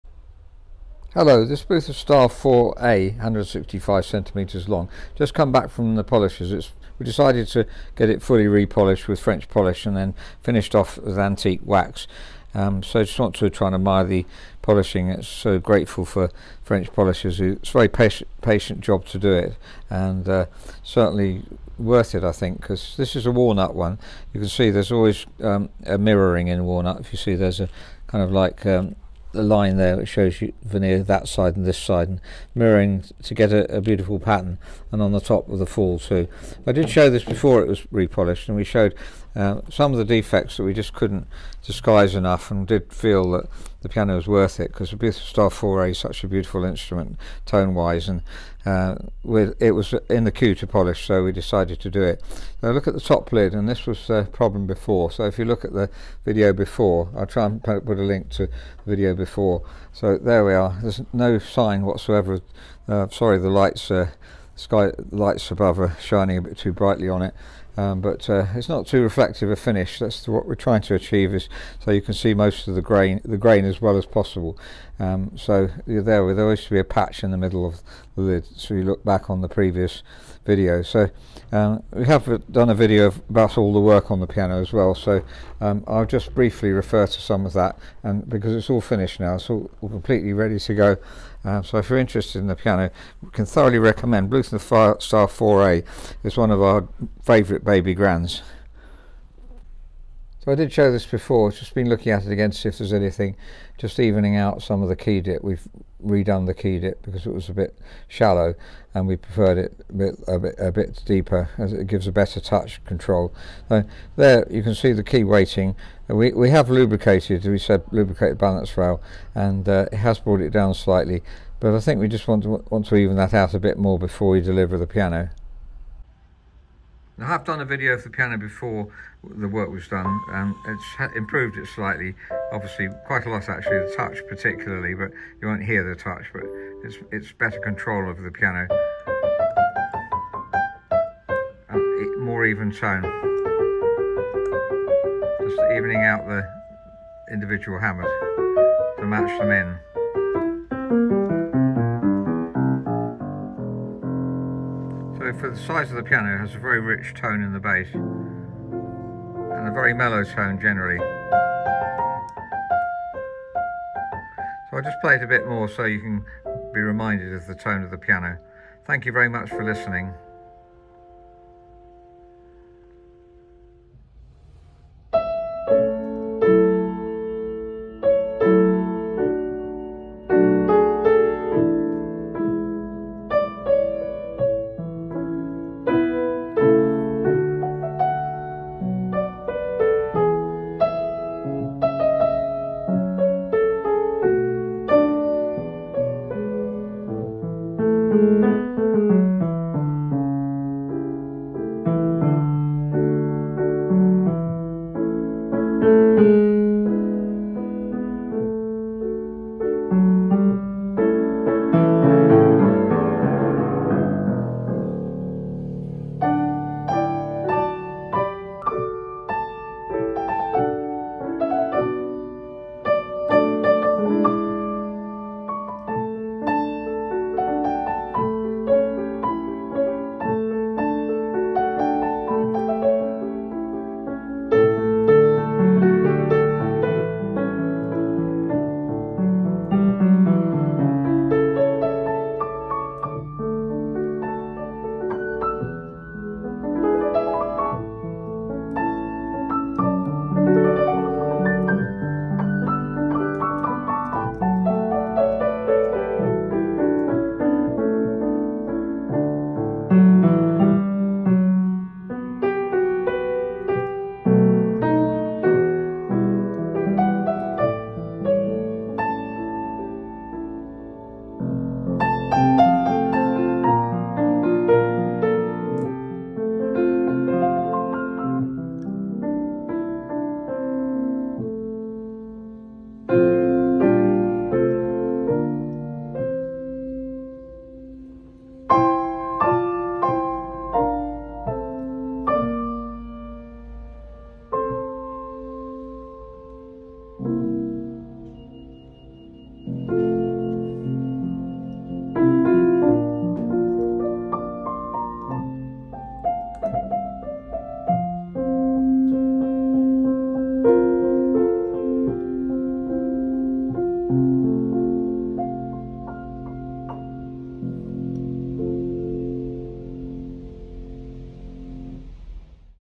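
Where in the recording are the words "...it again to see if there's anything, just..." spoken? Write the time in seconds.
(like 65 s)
102 s.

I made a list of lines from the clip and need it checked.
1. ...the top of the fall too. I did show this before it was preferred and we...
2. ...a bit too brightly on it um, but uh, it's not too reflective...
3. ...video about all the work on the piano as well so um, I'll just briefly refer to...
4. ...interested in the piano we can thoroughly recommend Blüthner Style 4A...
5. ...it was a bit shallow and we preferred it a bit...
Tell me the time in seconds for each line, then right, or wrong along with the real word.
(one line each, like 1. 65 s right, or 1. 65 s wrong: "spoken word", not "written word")
1. 35 s wrong: "repolished", not "preferred"
2. 66 s right
3. 82 s right
4. 91 s right
5. 107 s right.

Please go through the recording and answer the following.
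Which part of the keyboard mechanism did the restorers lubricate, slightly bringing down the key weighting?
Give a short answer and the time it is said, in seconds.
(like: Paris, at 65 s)
Balance rail, at 118 s.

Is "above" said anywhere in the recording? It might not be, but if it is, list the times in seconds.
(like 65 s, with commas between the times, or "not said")
65 s.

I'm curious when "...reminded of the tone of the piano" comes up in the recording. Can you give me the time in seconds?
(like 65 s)
166 s.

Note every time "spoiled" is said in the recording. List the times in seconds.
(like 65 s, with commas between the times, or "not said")
not said.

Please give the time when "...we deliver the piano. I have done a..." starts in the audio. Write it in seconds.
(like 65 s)
124 s.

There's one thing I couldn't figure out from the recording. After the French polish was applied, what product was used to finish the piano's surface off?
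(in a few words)
Antique wax.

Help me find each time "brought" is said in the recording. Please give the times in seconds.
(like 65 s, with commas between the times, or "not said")
120 s.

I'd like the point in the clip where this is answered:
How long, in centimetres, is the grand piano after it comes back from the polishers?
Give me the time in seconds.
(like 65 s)
3 s.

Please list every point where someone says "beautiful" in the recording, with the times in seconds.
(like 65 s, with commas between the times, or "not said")
33 s, 46 s.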